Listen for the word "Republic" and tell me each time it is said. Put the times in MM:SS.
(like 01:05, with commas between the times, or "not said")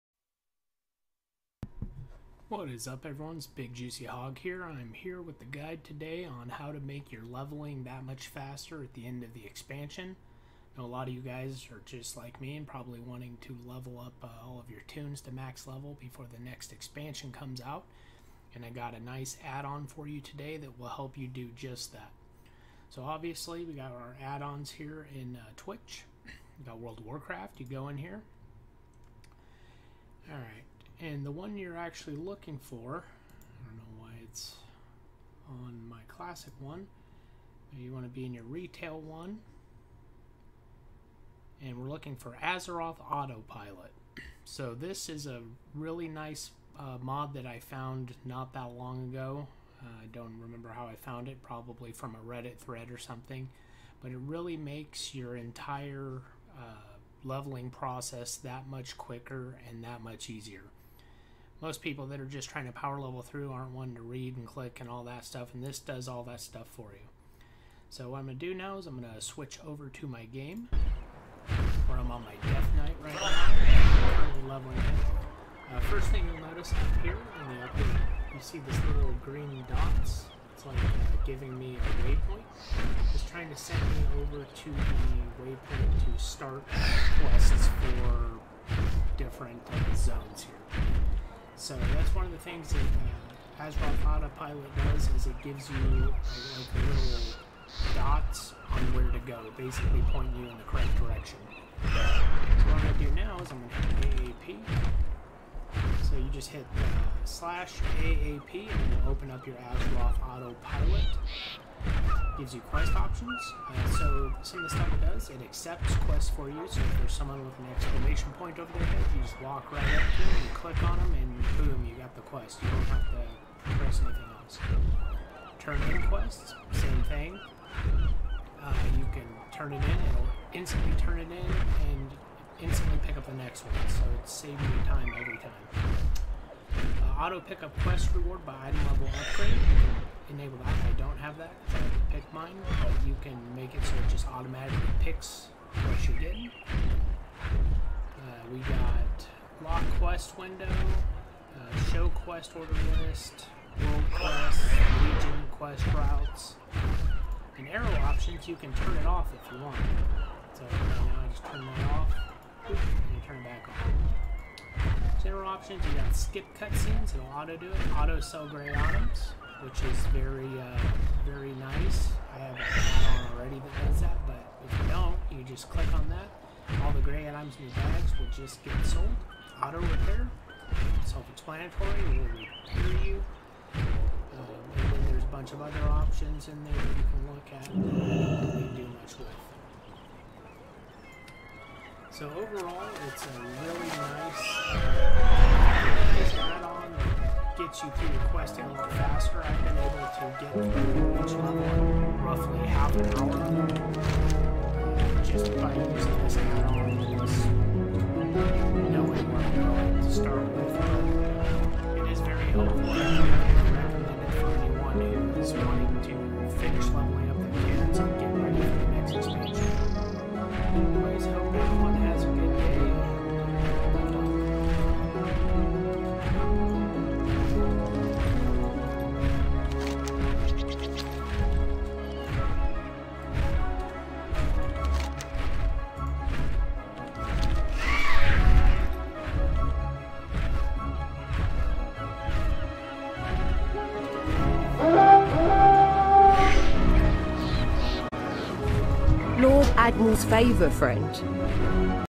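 not said.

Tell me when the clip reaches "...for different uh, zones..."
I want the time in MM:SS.
01:27.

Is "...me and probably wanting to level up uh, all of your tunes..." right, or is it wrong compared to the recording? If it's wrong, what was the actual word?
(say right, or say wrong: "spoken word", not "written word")
right.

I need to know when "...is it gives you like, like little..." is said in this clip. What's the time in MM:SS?
01:35.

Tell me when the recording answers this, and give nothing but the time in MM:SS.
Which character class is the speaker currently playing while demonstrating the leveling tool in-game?
01:12.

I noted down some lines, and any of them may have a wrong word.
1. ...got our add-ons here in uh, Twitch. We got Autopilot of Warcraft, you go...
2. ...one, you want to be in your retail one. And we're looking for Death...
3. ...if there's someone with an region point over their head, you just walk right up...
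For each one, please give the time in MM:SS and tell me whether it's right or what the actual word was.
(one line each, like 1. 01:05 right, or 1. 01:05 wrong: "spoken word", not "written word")
1. 00:23 wrong: "World", not "Autopilot"
2. 00:36 wrong: "Azeroth", not "Death"
3. 01:56 wrong: "exclamation", not "region".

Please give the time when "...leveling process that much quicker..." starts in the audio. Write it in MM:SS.
00:57.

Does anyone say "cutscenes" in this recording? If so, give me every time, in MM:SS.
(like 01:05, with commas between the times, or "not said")
02:46.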